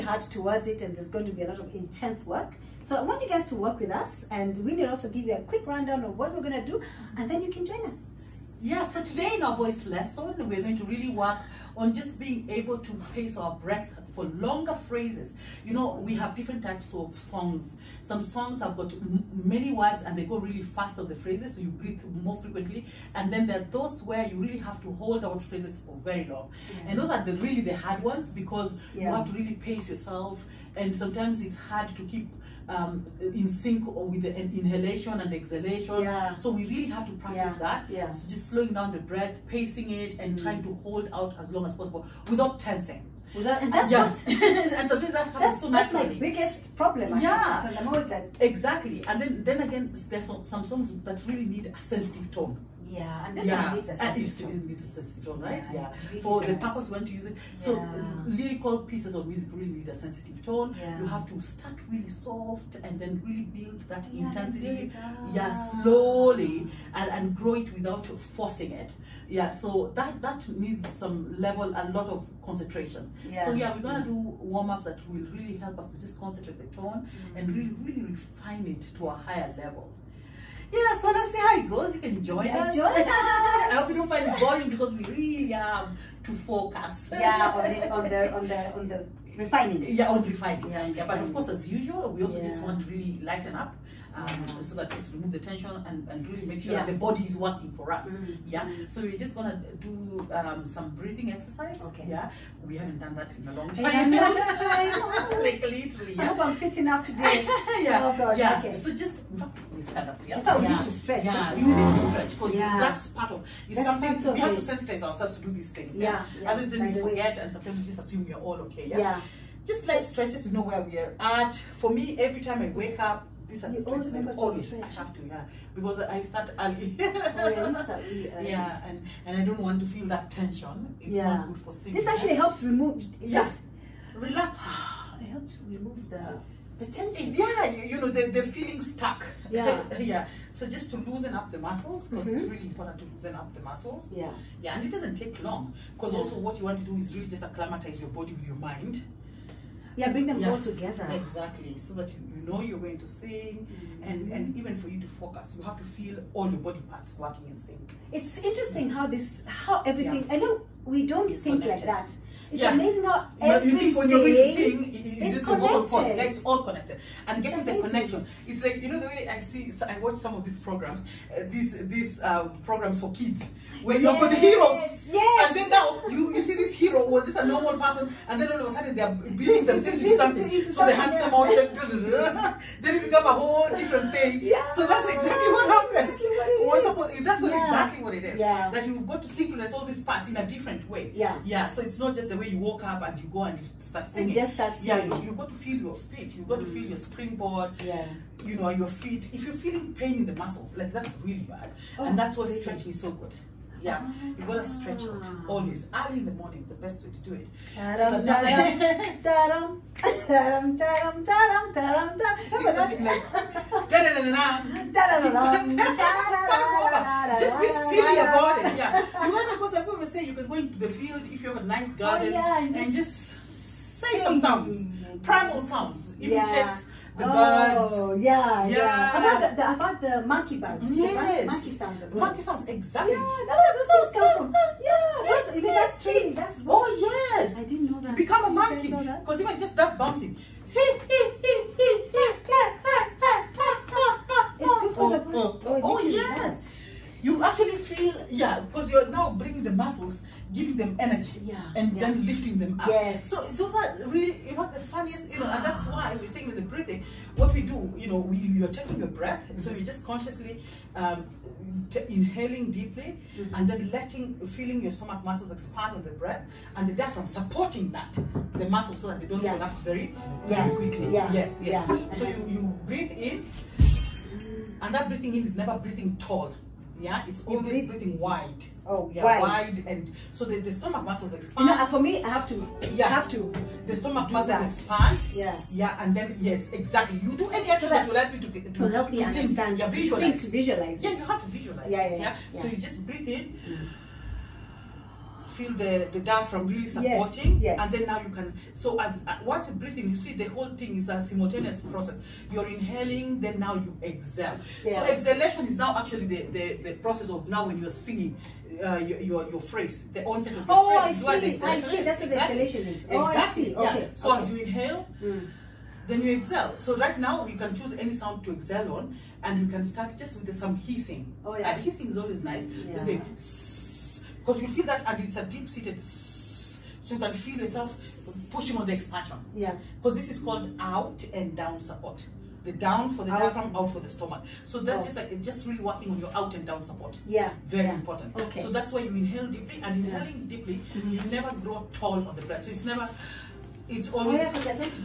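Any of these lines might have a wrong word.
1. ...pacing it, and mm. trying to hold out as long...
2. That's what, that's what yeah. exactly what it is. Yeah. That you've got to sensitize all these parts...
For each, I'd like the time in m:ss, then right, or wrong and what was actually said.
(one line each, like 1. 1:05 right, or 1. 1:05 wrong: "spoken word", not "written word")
1. 0:39 right
2. 3:06 wrong: "synchronize", not "sensitize".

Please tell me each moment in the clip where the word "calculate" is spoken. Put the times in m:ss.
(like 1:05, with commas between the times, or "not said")
not said.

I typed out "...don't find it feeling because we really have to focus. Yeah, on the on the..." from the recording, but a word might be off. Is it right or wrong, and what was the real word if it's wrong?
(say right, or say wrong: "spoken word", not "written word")
wrong: "boring", not "feeling".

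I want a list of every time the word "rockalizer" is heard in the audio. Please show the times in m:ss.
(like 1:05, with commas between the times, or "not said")
not said.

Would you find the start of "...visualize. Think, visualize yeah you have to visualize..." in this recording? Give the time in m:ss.
4:49.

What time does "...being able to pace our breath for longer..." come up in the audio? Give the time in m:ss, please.
0:12.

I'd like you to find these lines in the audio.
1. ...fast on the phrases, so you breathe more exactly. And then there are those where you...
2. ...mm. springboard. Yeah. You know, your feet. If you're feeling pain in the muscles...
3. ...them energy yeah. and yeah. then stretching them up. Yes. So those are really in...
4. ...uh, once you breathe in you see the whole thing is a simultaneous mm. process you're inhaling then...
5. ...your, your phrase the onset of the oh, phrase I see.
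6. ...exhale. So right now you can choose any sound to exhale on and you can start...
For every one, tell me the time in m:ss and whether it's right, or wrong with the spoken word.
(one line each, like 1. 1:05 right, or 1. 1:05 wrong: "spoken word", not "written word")
1. 0:20 wrong: "frequently", not "exactly"
2. 3:16 right
3. 4:10 wrong: "lifting", not "stretching"
4. 4:59 right
5. 5:09 right
6. 5:16 right.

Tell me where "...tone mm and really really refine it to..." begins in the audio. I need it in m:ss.
1:16.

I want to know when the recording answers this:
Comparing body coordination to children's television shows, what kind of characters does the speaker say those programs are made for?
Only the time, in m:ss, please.
2:54.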